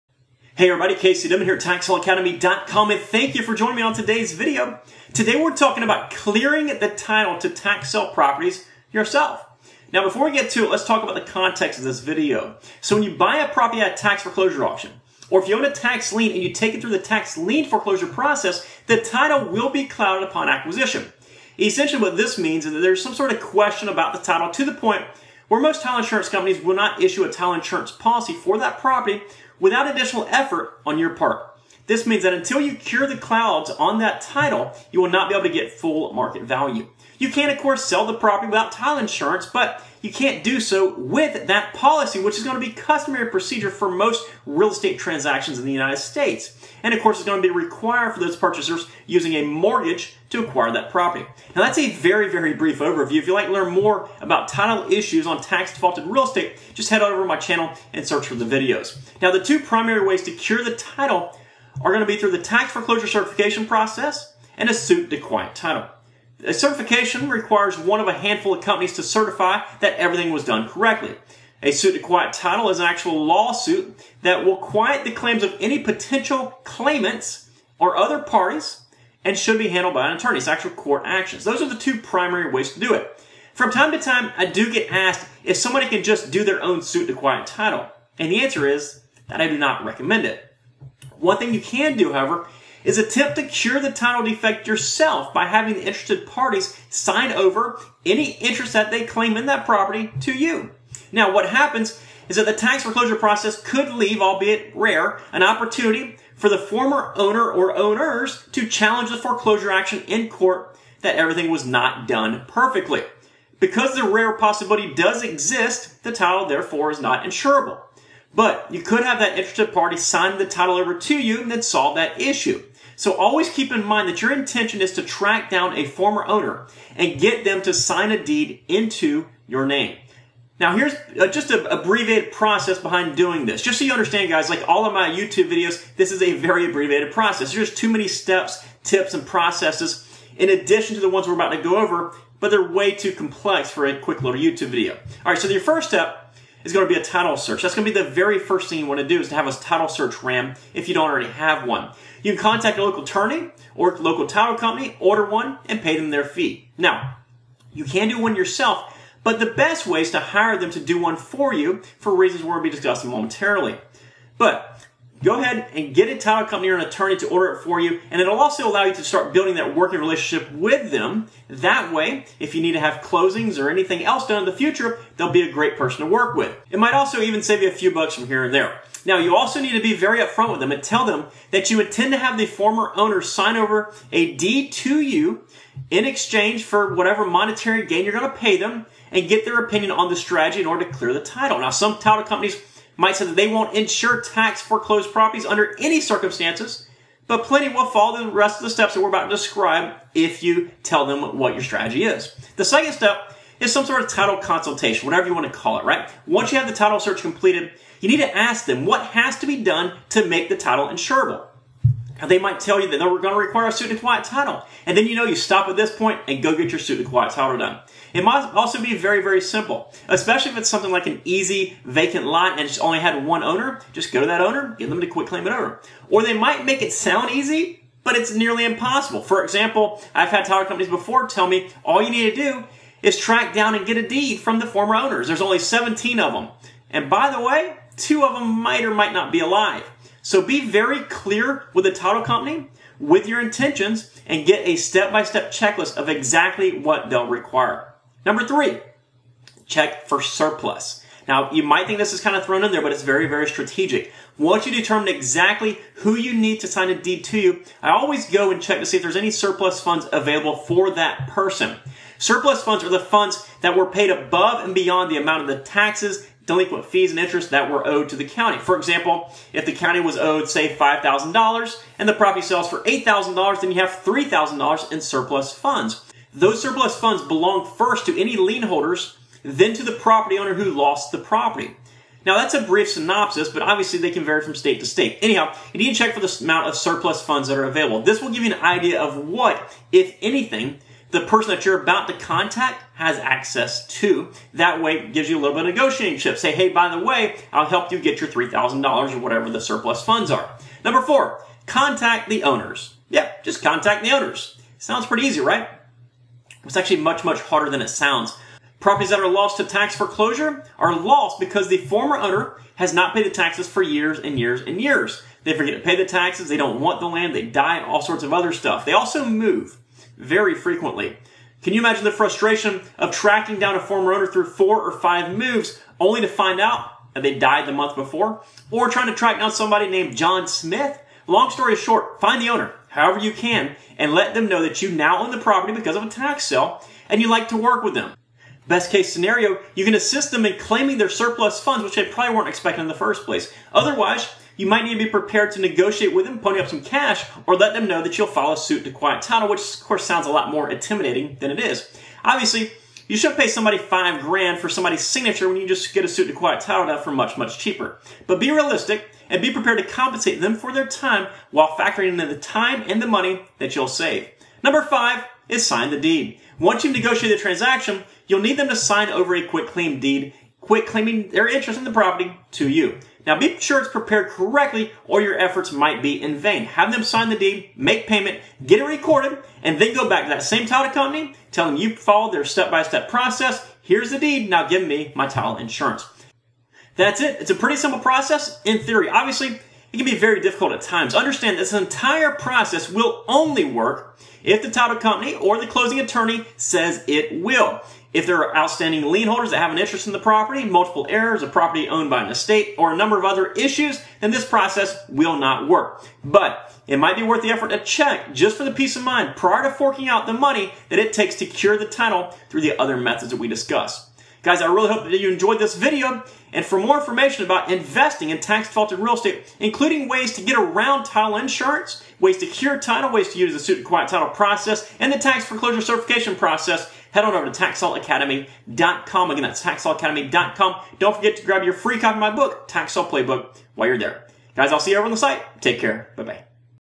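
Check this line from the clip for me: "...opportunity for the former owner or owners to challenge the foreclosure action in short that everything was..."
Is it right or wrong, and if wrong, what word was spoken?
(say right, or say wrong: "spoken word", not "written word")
wrong: "court", not "short".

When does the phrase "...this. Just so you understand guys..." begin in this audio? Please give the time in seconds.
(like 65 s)
133 s.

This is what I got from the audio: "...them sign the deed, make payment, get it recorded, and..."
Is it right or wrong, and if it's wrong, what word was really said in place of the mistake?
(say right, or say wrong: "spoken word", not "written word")
right.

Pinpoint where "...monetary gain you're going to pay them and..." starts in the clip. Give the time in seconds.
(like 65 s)
187 s.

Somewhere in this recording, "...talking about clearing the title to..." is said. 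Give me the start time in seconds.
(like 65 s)
5 s.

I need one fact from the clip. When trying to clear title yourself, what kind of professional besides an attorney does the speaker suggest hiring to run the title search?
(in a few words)
Local title company.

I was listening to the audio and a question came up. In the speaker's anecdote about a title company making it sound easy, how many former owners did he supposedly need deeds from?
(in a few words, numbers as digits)
17.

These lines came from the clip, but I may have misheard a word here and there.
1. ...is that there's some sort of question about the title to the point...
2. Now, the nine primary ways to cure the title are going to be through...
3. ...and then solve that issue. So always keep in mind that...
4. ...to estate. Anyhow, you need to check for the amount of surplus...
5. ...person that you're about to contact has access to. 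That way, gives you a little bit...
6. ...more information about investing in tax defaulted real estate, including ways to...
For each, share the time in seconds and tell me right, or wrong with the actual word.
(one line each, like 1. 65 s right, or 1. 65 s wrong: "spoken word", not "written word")
1. 22 s right
2. 59 s wrong: "two", not "nine"
3. 121 s right
4. 284 s wrong: "state", not "estate"
5. 291 s right
6. 416 s right.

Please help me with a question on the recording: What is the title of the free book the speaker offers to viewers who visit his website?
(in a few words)
Tax Sale Playbook.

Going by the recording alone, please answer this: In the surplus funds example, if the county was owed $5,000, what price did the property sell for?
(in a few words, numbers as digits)
$8,000.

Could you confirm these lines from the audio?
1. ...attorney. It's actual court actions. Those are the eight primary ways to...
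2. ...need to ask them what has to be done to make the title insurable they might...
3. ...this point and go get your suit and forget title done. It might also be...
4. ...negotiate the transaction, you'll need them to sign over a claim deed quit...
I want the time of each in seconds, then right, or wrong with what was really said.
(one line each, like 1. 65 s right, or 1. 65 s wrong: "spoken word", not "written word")
1. 80 s wrong: "two", not "eight"
2. 208 s right
3. 215 s wrong: "quiet", not "forget"
4. 366 s right.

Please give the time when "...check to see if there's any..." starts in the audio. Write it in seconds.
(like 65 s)
258 s.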